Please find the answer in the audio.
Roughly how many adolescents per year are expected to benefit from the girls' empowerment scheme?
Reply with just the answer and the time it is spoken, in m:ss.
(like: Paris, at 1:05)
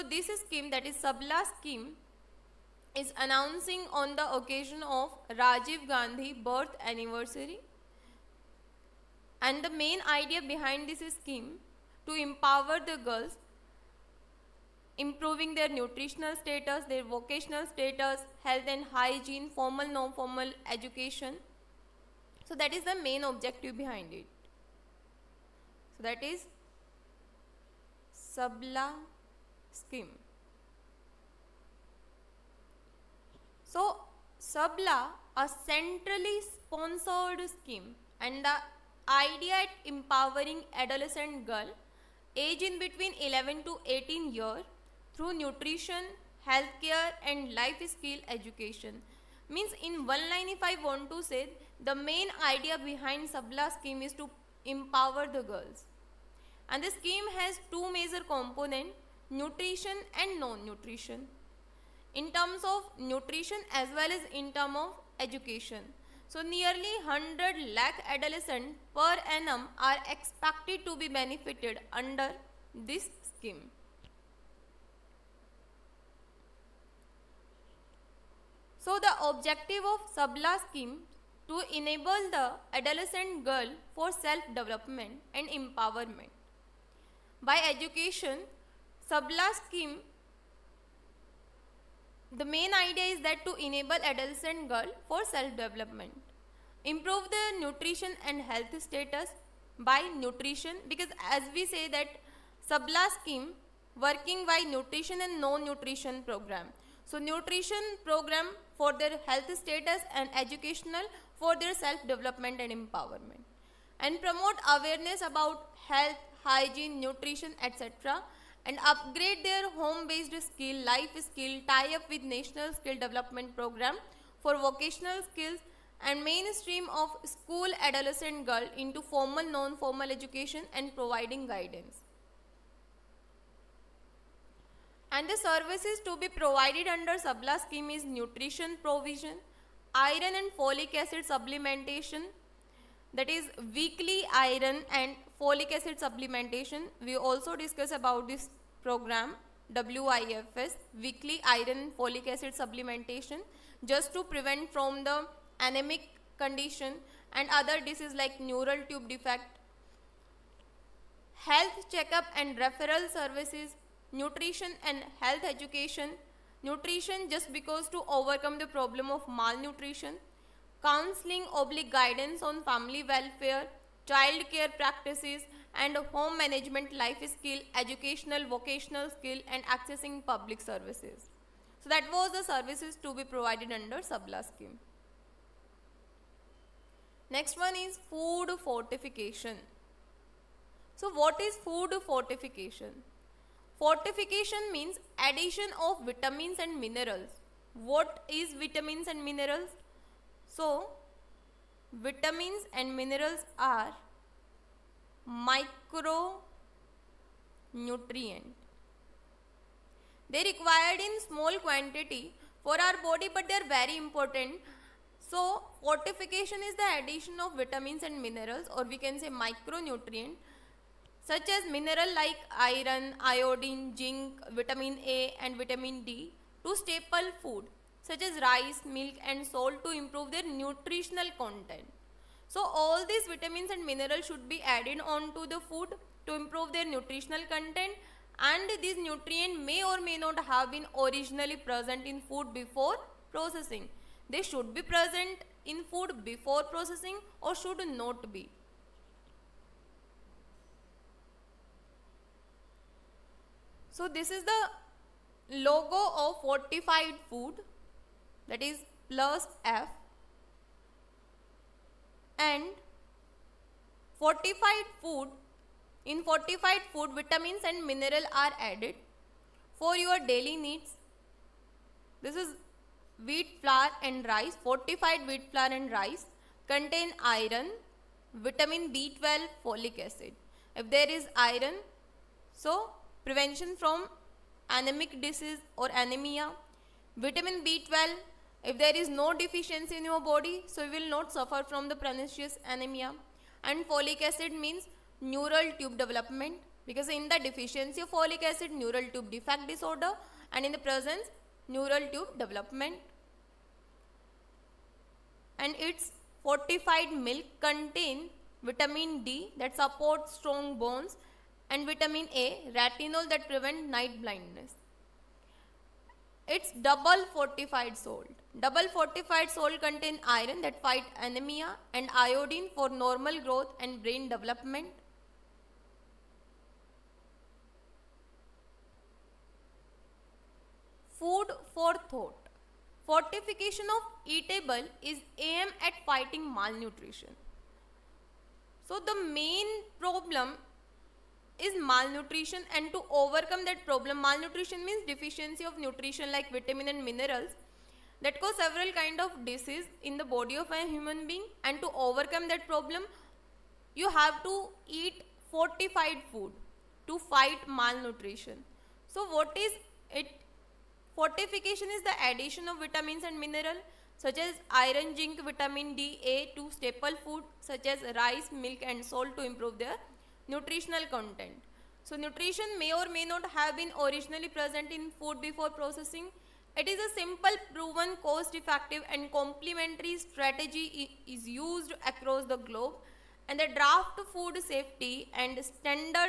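100 lakh, at 1:07.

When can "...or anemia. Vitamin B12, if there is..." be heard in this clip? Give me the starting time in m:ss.
4:45.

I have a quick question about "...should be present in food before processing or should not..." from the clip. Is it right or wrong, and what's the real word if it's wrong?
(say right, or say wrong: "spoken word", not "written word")
right.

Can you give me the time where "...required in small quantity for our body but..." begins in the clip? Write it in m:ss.
3:30.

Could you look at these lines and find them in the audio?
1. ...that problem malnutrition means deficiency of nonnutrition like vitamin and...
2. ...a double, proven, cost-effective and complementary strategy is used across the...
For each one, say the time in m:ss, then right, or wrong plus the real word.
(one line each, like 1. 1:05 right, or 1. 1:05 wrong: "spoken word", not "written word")
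1. 5:43 wrong: "nutrition", not "nonnutrition"
2. 6:16 wrong: "simple", not "double".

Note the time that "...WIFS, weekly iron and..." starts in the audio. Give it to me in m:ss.
2:29.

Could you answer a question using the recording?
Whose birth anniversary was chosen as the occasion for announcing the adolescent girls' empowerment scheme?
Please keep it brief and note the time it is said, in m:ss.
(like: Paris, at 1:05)
Rajiv Gandhi, at 0:05.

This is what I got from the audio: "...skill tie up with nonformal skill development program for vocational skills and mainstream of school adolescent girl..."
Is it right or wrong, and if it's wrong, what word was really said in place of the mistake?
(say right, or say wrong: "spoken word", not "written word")
wrong: "national", not "nonformal".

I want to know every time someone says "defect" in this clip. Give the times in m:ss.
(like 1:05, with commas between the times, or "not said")
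2:39, 4:59.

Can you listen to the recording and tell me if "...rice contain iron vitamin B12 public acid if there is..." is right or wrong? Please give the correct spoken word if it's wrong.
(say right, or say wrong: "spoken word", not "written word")
wrong: "folic", not "public".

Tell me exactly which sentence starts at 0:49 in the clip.
Means in one line if I want to say the main idea behind Sabla scheme is to empower the girls.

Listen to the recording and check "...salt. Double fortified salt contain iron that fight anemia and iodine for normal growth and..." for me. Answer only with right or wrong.
right.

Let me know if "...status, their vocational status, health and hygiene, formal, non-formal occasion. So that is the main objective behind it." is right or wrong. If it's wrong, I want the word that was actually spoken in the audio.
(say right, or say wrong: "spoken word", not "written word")
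wrong: "education", not "occasion".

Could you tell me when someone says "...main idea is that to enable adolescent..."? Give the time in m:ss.
1:32.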